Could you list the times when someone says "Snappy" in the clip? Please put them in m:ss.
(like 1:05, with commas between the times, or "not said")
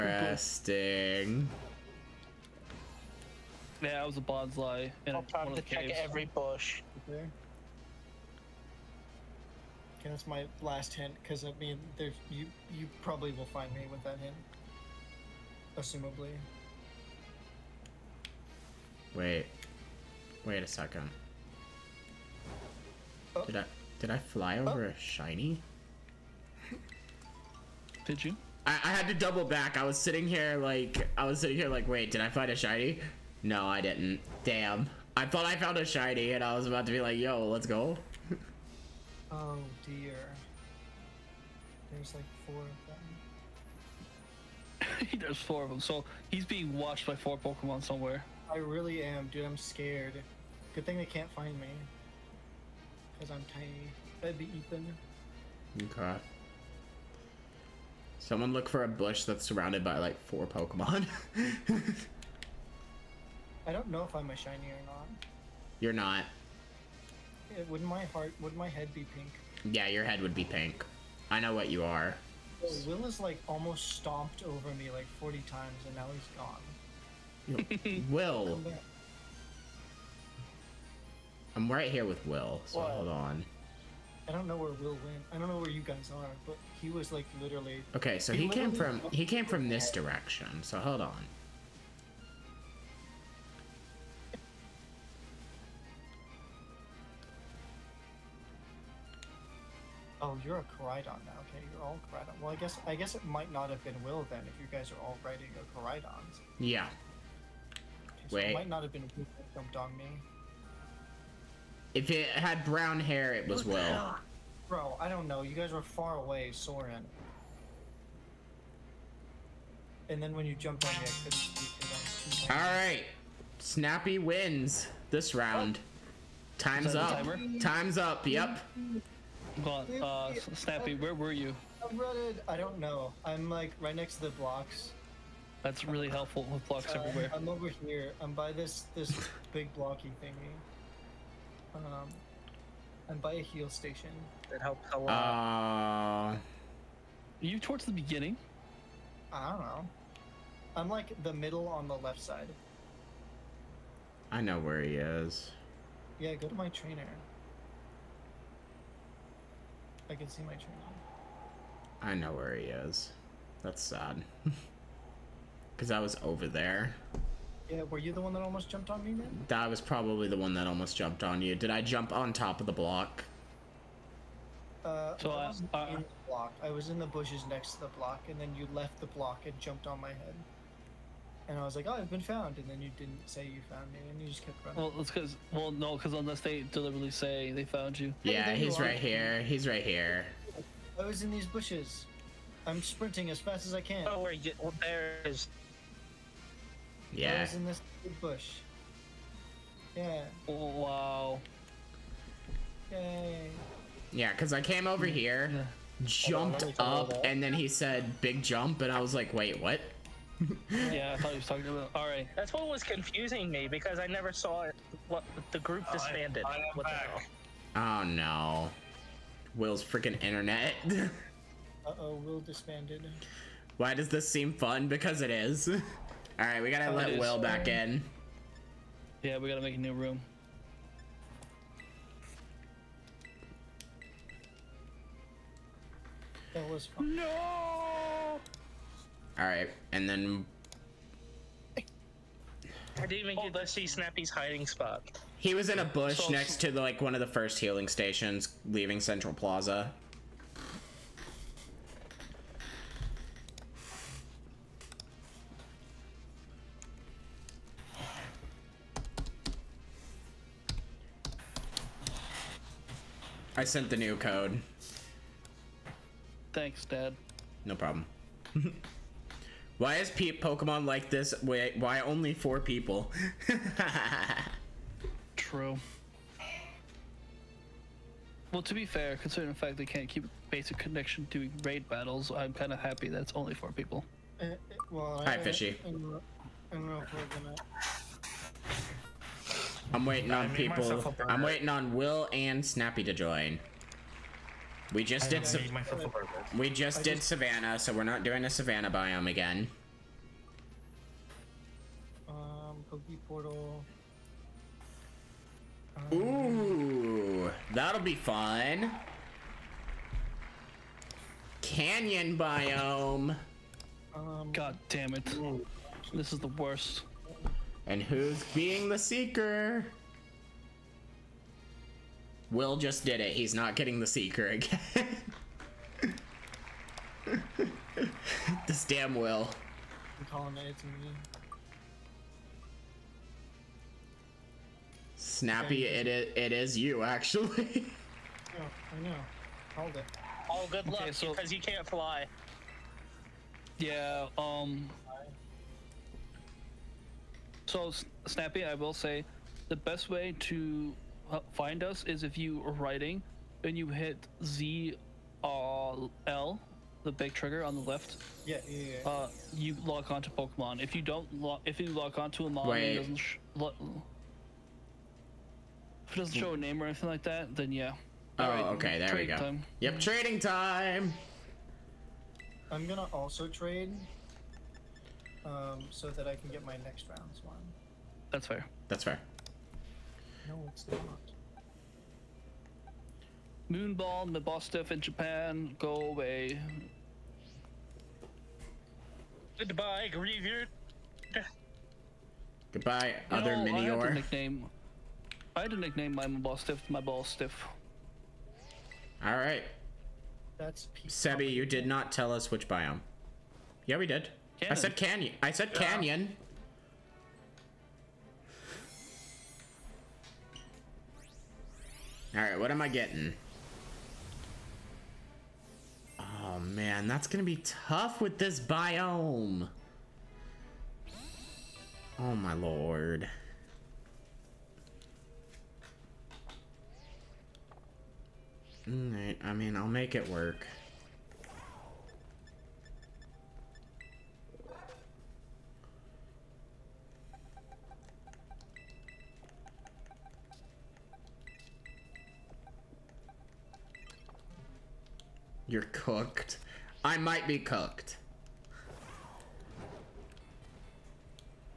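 2:03, 2:10, 4:03, 4:52, 5:35, 5:48.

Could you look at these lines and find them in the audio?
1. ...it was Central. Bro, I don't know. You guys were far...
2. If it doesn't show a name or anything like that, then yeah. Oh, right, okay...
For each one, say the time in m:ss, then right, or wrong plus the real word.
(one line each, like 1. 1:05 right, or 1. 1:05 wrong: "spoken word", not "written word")
1. 1:53 wrong: "Will", not "Central"
2. 6:06 right.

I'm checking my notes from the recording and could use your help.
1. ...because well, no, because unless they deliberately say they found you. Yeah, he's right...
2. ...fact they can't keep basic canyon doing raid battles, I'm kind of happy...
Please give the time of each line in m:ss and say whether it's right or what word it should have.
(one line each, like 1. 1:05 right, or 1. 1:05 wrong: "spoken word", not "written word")
1. 3:05 right
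2. 4:39 wrong: "connection", not "canyon".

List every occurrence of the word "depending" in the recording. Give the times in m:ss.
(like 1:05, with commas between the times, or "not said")
not said.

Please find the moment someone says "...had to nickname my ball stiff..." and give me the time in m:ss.
6:35.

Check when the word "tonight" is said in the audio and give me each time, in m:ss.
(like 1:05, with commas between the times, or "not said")
not said.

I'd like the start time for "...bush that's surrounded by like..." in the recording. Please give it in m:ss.
0:58.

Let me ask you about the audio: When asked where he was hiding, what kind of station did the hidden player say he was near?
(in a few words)
A heal station.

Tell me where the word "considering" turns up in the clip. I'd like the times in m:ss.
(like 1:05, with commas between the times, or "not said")
4:39.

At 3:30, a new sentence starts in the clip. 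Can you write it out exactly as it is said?
yeah, I thought he was talking about.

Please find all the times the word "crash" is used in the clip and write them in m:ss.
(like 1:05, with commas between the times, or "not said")
not said.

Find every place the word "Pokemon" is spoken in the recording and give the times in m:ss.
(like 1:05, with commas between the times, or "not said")
0:47, 1:00, 4:30, 6:00.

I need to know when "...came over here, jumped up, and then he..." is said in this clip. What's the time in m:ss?
3:24.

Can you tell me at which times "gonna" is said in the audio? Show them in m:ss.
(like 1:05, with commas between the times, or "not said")
4:45, 6:12, 6:57.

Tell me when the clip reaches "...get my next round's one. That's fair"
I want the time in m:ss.
6:16.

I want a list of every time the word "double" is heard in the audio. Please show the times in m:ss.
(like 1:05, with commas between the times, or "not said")
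0:29.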